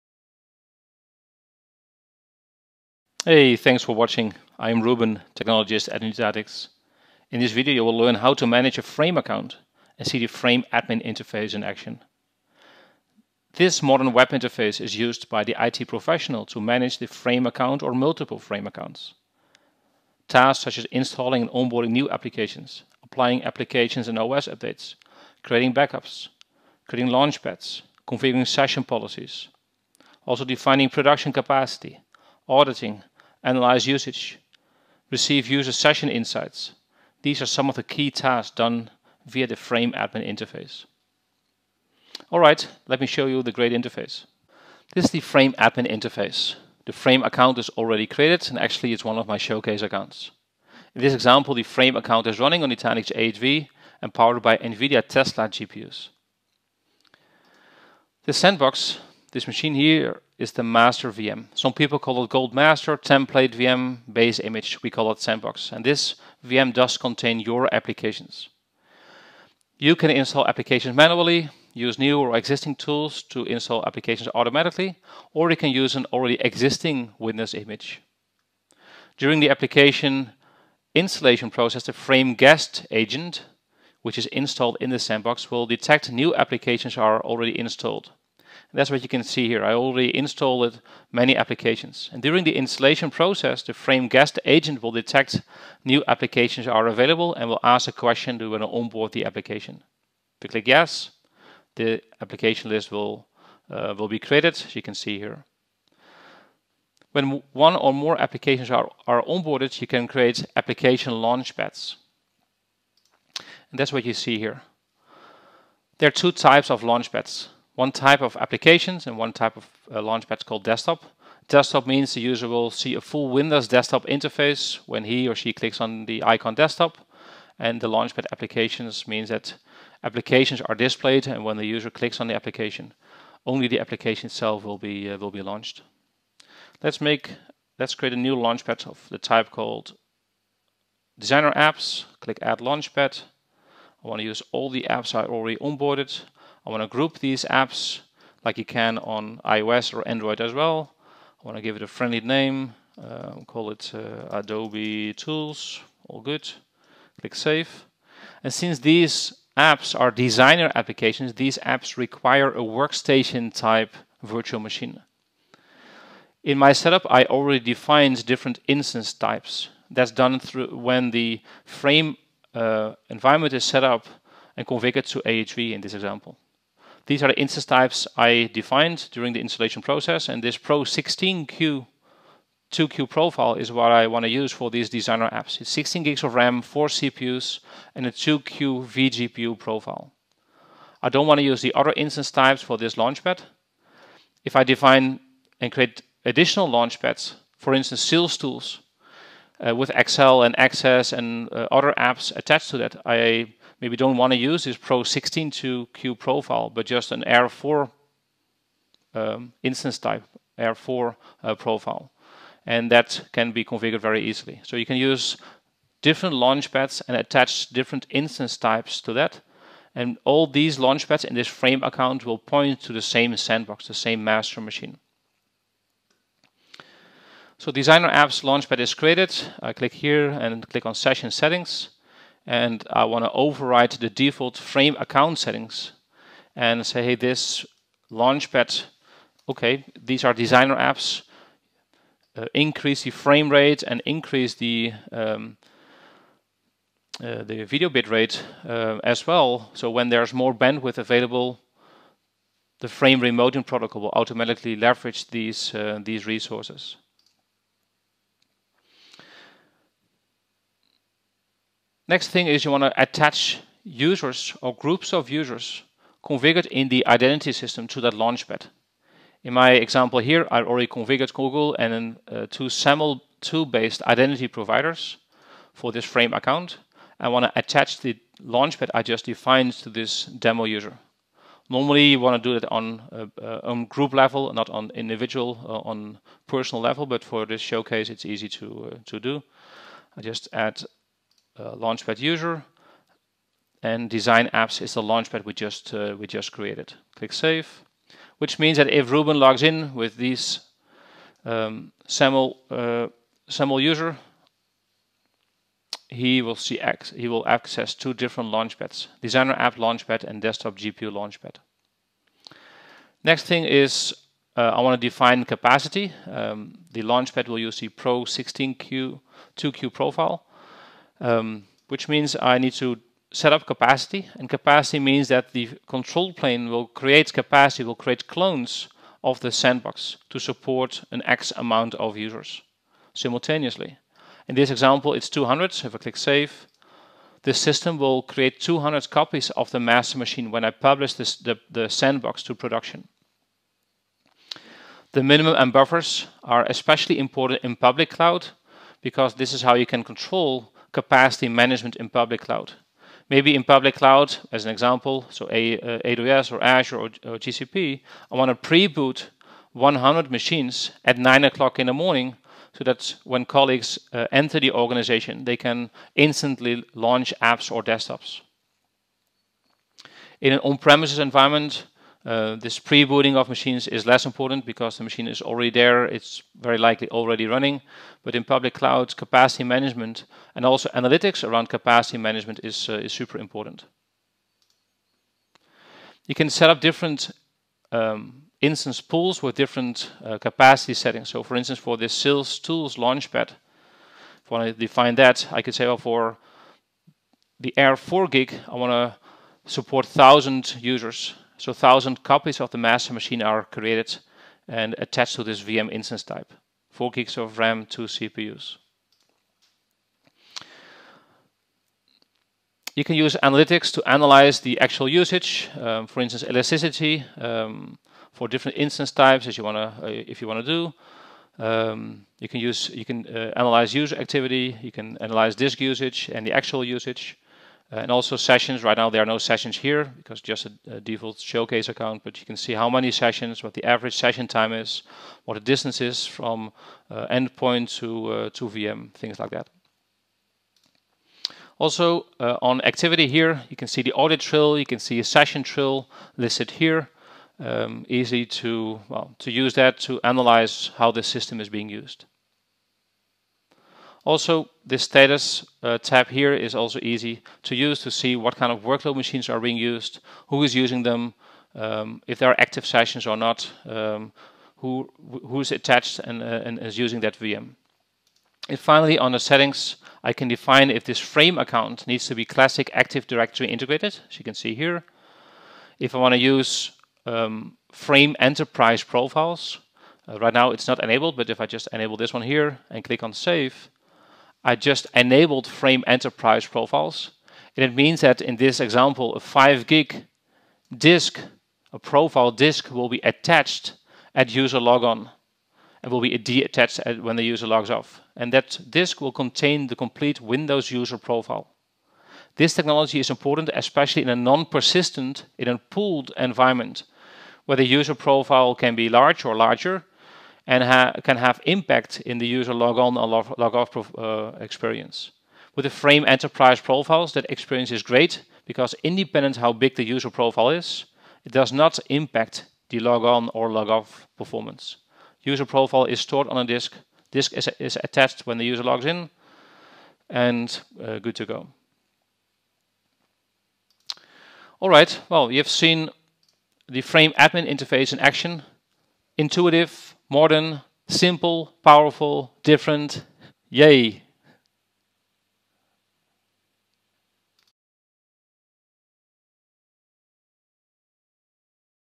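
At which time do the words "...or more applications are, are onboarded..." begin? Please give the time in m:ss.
1:47.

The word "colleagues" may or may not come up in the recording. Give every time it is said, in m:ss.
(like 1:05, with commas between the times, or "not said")
6:03.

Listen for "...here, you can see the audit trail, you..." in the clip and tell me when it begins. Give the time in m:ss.
7:23.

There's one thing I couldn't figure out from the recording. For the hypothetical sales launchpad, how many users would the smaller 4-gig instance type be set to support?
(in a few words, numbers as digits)
1,000.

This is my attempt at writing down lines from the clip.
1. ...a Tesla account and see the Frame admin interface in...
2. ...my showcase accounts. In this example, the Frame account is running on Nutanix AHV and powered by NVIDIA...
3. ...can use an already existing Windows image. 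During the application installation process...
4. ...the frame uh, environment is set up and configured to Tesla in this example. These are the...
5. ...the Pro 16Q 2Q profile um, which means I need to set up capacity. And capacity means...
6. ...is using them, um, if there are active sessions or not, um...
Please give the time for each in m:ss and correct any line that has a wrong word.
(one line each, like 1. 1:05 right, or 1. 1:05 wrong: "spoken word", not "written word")
1. 0:08 wrong: "Frame", not "Tesla"
2. 0:49 right
3. 1:15 right
4. 2:51 wrong: "AHV", not "Tesla"
5. 5:17 right
6. 7:40 right.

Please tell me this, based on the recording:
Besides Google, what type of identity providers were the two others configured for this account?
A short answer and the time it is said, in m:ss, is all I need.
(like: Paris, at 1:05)
SAML2-based, at 4:32.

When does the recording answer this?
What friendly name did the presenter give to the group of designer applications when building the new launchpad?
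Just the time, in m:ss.
2:34.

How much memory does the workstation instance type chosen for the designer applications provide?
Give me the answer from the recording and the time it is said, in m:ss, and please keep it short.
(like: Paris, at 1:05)
16 GB, at 3:05.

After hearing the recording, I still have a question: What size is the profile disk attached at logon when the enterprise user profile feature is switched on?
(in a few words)
5 GB.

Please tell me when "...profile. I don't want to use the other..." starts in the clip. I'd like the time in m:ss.
3:09.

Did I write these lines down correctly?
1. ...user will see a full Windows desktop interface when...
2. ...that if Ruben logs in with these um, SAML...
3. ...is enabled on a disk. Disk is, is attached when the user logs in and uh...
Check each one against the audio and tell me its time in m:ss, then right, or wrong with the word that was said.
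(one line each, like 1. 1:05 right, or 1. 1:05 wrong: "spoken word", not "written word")
1. 2:02 right
2. 4:58 right
3. 8:46 wrong: "stored", not "enabled".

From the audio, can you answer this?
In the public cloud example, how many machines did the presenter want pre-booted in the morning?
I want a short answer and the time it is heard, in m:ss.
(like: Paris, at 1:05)
100, at 5:59.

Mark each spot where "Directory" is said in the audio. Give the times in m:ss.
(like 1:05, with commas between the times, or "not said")
7:53.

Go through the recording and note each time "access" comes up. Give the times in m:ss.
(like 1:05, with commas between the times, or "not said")
3:20, 5:07.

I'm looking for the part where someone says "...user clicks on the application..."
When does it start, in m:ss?
2:11.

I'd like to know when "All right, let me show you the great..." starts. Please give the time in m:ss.
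0:42.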